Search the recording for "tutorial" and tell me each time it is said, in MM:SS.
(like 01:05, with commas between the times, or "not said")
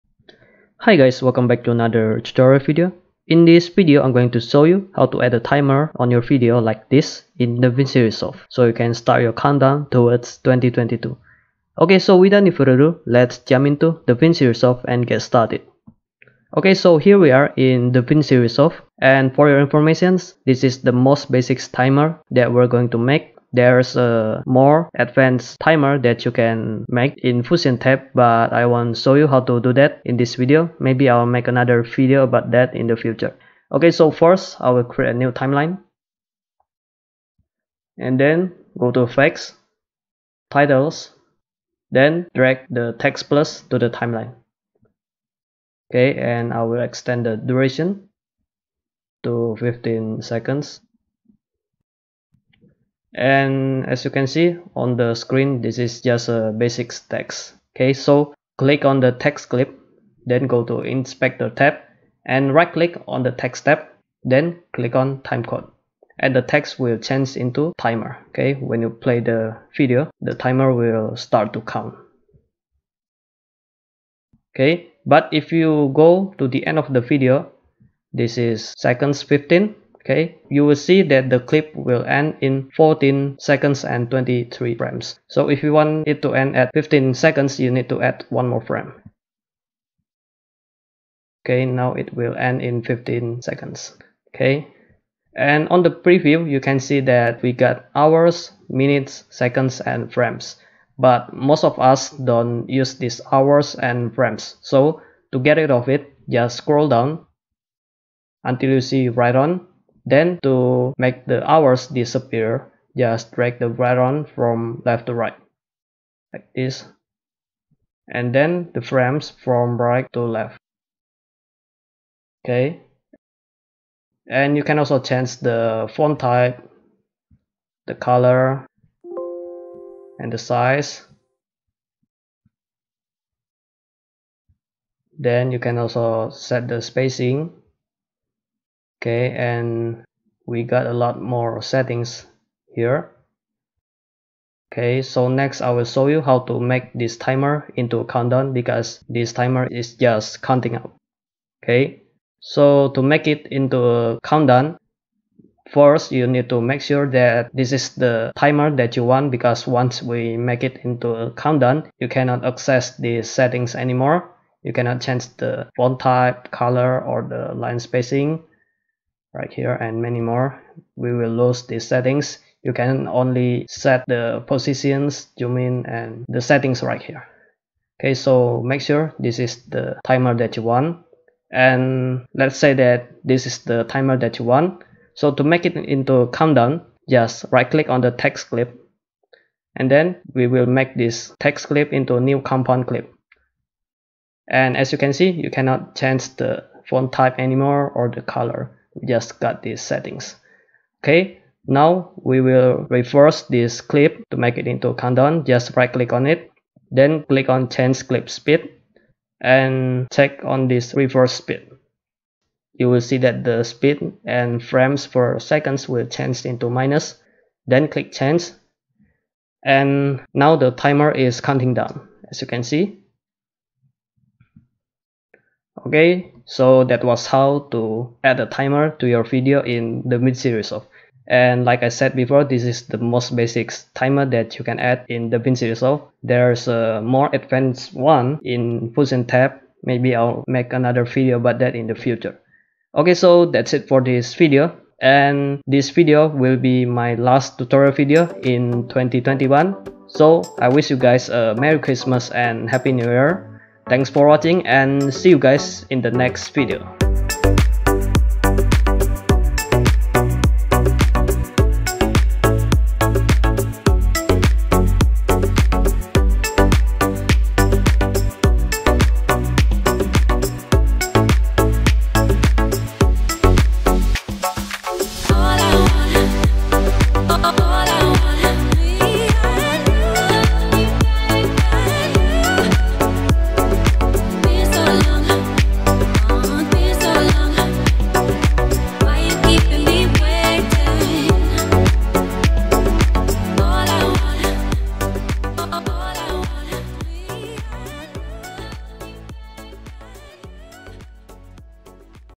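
00:02, 04:07.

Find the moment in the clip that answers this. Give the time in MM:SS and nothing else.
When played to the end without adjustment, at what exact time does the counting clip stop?
01:22.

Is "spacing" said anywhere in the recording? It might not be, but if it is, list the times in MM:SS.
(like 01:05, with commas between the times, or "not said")
02:16, 02:47.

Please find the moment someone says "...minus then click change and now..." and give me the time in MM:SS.
03:36.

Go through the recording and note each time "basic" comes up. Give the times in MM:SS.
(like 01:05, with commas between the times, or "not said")
00:21, 00:56, 03:53.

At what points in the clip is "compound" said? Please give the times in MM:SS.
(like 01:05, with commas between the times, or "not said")
03:12.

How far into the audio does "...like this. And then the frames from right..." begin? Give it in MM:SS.
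01:56.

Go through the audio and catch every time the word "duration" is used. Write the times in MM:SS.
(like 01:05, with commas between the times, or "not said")
00:47.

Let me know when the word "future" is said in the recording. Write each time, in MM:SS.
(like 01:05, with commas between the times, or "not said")
00:32, 04:01.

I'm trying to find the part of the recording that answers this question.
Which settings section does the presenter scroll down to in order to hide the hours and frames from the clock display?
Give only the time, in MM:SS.
01:49.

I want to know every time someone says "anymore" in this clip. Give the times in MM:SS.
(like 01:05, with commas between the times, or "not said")
02:43, 03:17.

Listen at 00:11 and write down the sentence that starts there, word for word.
Okay, so without any further ado, let's jump into the Resolve and get started.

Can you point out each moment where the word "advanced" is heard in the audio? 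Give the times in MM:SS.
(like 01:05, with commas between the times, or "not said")
00:24, 03:57.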